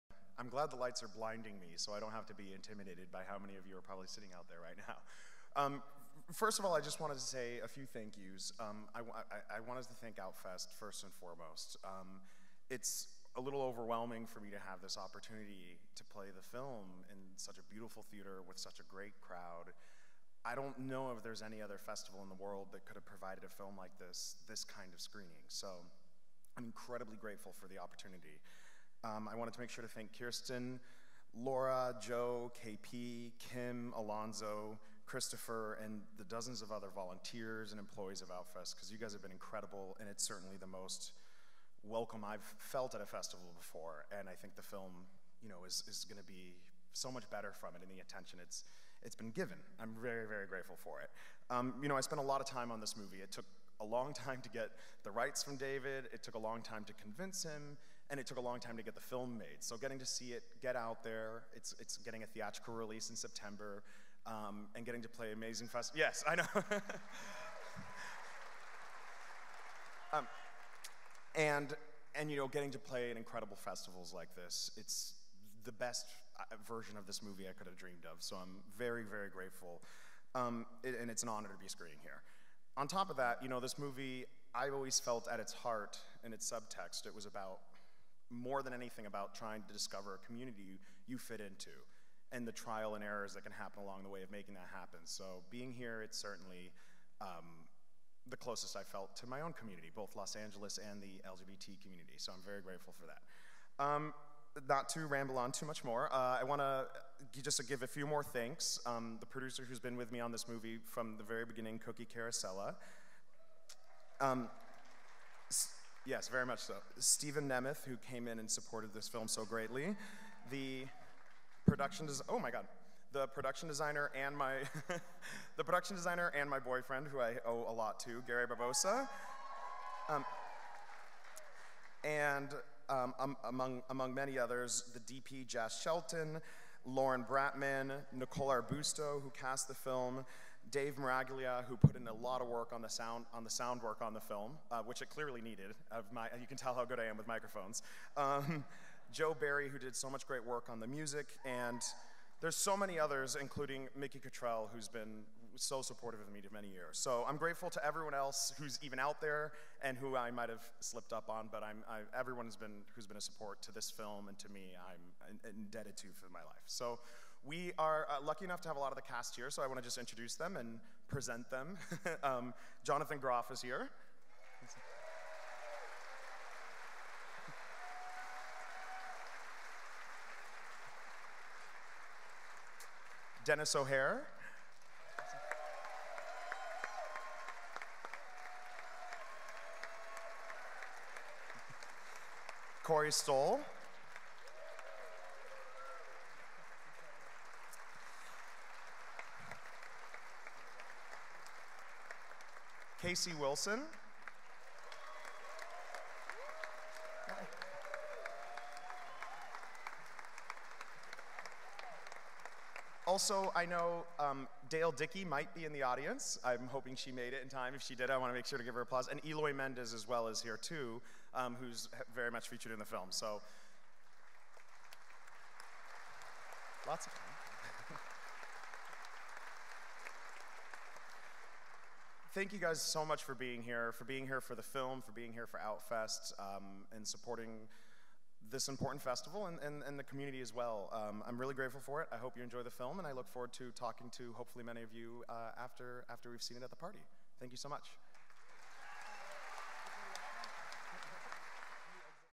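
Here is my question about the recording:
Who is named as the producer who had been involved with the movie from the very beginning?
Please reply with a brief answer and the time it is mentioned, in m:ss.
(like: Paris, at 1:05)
Cookie Carosella, at 1:51.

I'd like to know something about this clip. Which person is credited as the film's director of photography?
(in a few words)
Jas Shelton.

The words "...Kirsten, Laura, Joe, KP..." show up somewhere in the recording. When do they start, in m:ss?
0:30.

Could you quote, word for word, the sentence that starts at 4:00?
Um, I'm really grateful for it.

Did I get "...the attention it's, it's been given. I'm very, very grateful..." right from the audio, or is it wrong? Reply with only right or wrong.
right.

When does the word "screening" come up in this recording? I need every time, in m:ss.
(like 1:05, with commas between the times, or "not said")
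0:25, 1:21.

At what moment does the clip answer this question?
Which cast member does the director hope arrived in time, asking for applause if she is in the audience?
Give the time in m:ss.
3:34.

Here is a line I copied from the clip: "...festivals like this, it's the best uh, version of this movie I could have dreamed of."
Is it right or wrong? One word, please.
right.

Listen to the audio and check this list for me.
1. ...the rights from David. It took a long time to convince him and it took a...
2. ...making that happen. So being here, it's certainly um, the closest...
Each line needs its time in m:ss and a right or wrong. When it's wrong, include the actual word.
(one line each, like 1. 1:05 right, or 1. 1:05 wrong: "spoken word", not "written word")
1. 0:55 right
2. 1:34 right.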